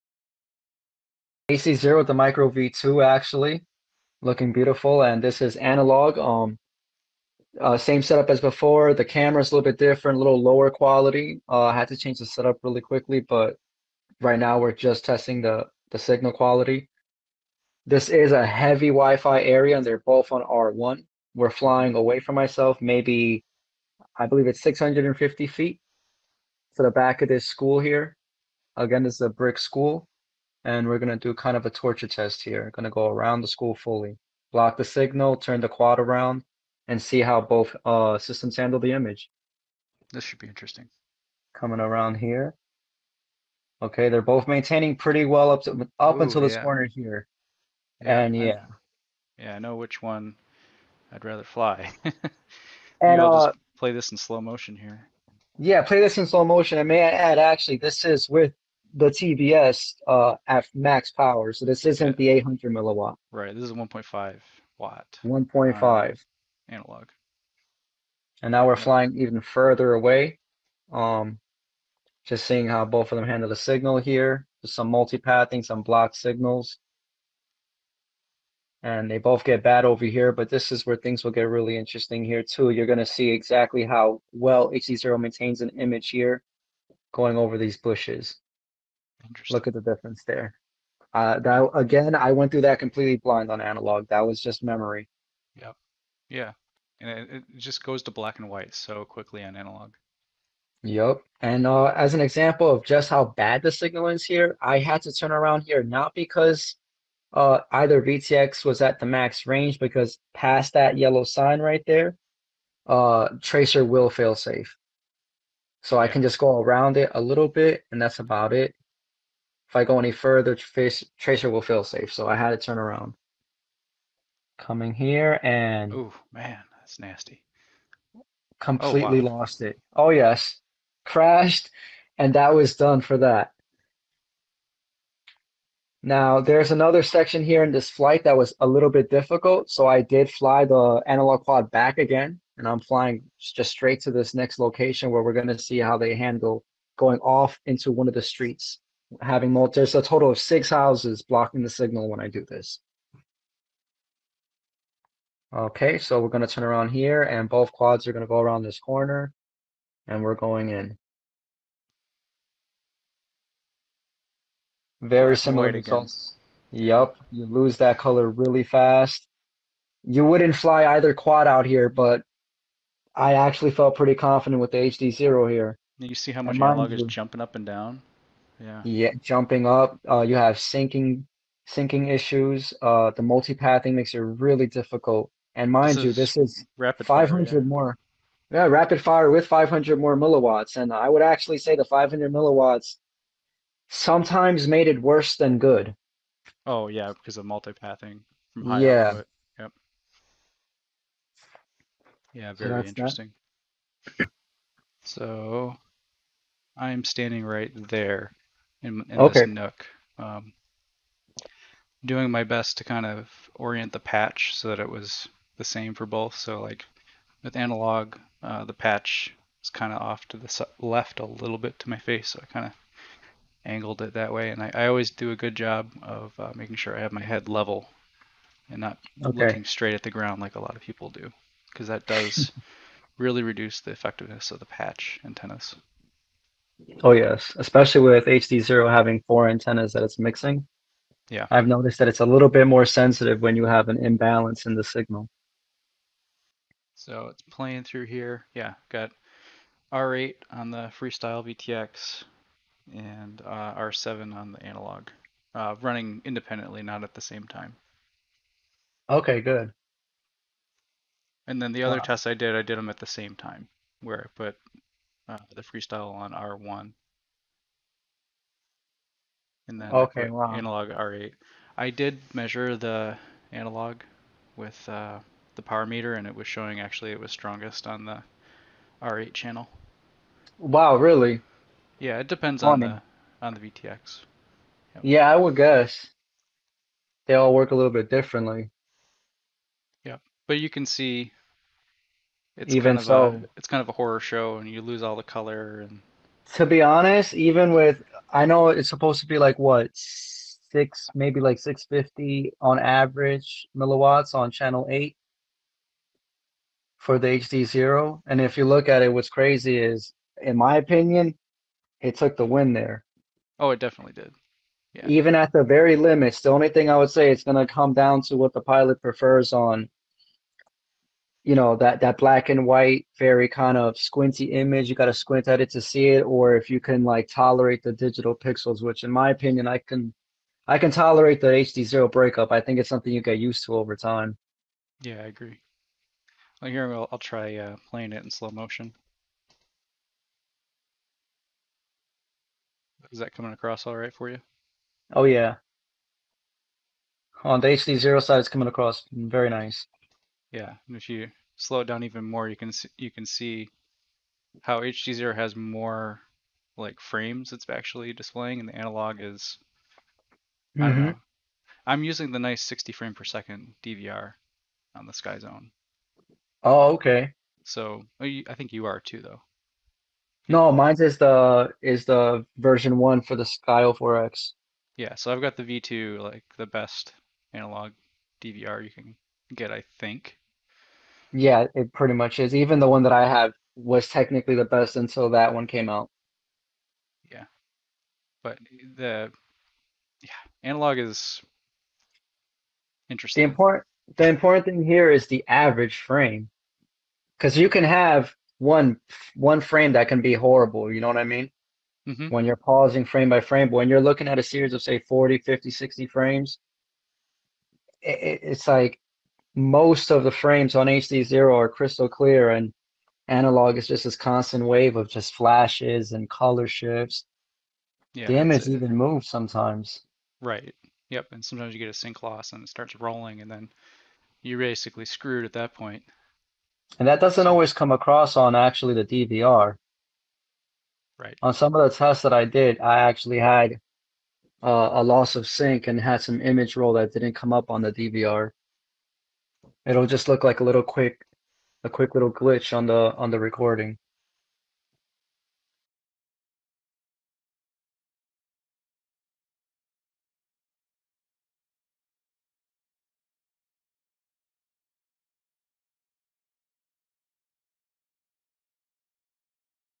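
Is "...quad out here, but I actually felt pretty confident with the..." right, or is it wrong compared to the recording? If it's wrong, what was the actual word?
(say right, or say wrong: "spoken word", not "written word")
right.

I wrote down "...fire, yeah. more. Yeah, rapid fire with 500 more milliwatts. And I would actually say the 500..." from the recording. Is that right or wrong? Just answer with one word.
right.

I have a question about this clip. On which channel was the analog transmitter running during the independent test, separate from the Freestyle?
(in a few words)
R7.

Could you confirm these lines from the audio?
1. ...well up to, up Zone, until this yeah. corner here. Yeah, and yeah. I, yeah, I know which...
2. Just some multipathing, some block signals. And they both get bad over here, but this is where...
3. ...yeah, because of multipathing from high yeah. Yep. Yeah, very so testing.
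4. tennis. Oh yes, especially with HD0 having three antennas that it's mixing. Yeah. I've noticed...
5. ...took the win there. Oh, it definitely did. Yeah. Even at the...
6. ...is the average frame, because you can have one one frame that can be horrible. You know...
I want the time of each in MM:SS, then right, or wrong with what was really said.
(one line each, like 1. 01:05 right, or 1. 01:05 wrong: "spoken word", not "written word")
1. 00:45 wrong: "Ooh", not "Zone"
2. 01:14 right
3. 03:16 wrong: "interesting", not "testing"
4. 03:55 wrong: "four", not "three"
5. 05:12 right
6. 06:35 right.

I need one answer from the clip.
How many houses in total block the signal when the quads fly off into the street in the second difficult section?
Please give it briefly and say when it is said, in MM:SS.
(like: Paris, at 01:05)
6, at 02:30.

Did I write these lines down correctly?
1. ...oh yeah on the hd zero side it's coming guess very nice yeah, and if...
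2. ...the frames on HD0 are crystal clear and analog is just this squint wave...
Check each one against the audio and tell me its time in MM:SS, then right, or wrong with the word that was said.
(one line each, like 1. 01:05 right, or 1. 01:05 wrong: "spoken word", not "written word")
1. 05:45 wrong: "across", not "guess"
2. 06:50 wrong: "constant", not "squint".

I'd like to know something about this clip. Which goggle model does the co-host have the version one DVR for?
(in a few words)
Sky 04X.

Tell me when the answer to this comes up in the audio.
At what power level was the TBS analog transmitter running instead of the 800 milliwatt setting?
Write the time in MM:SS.
01:03.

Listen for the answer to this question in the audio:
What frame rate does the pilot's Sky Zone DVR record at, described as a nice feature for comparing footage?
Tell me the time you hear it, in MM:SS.
06:02.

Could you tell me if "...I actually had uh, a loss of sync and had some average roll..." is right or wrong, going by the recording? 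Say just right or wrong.
wrong.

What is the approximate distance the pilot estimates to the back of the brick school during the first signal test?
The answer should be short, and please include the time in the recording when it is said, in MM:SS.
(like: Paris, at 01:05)
650 feet, at 00:24.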